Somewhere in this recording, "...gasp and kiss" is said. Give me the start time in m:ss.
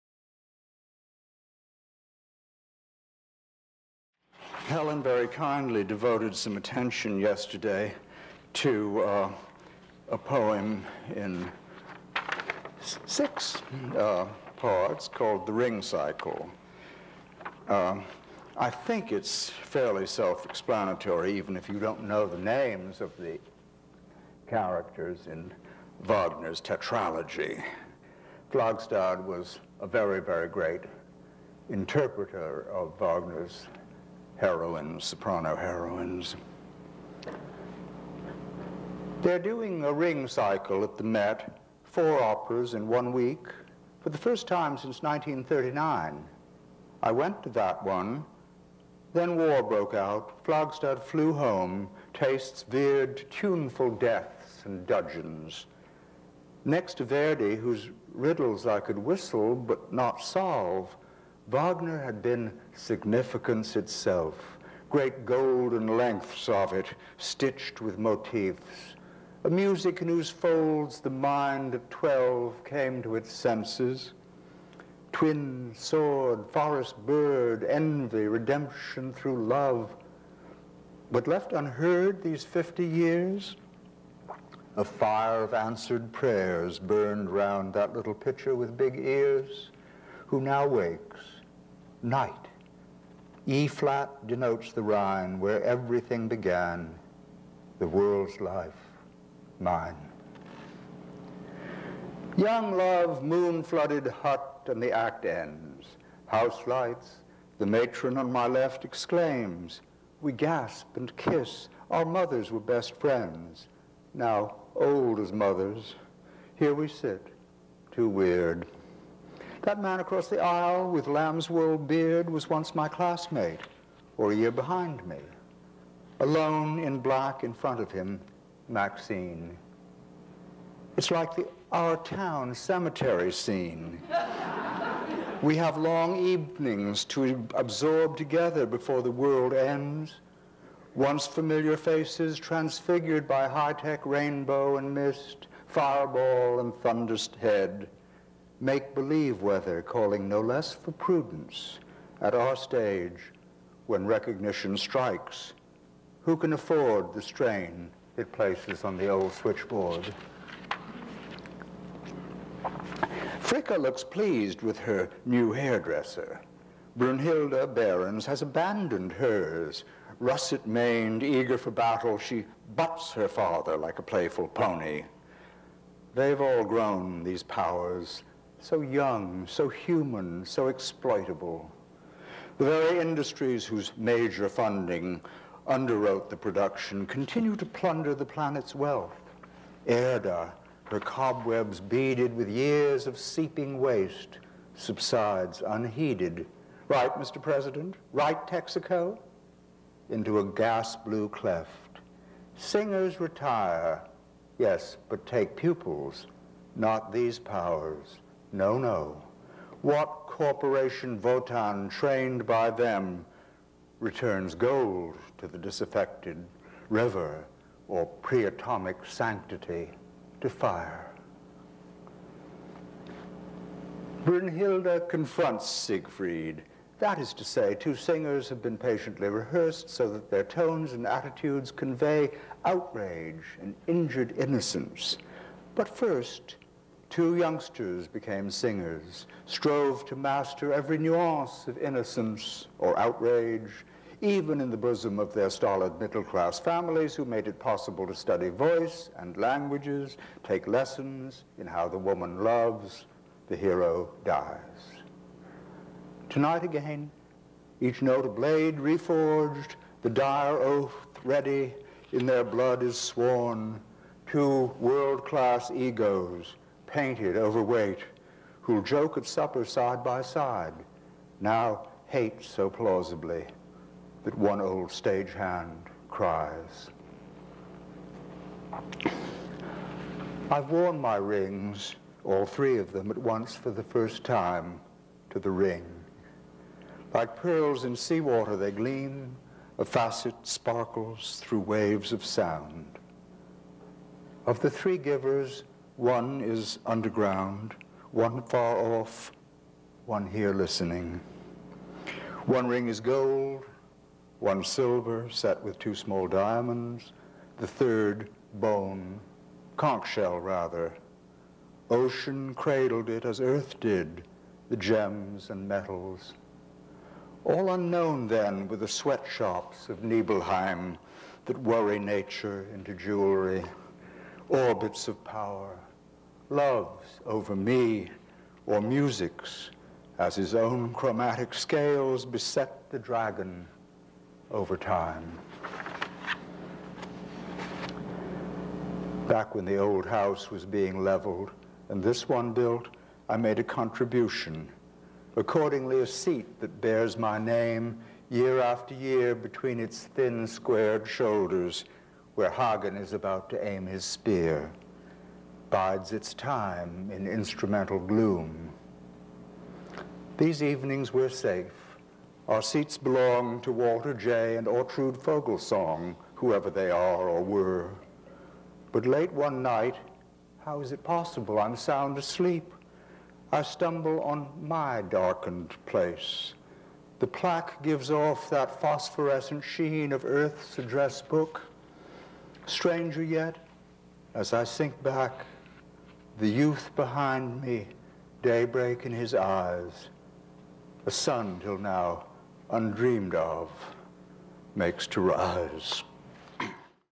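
1:50.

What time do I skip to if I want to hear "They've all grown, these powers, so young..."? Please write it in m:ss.
2:56.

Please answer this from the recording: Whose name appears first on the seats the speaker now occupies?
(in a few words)
Walter Jay.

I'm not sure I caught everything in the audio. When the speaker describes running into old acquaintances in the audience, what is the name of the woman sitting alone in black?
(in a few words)
Maxine.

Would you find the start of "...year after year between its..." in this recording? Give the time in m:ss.
5:48.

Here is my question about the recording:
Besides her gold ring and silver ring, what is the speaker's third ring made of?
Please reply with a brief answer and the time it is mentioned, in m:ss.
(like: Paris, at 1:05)
Conch shell, at 5:09.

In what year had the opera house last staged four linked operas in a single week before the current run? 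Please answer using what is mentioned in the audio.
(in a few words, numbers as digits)
1939.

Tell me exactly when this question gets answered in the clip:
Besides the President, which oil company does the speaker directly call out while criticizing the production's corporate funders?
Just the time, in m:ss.
3:18.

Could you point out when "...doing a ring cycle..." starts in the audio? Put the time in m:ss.
0:39.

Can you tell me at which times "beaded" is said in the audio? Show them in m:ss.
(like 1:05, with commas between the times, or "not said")
3:11.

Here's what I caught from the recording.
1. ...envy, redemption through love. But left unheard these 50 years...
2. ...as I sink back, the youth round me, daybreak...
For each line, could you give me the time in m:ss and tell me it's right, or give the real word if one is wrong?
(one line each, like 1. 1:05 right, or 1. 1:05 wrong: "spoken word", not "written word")
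1. 1:17 right
2. 6:24 wrong: "behind", not "round".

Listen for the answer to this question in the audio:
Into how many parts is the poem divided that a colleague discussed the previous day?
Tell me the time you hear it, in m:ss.
0:13.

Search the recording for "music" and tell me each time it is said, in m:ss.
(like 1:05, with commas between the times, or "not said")
1:09, 5:28.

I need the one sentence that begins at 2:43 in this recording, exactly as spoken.
Fricka looks pleased with her new hairdresser.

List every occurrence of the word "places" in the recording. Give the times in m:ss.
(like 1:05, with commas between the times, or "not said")
2:38, 6:15.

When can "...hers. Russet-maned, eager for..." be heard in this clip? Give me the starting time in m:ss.
2:49.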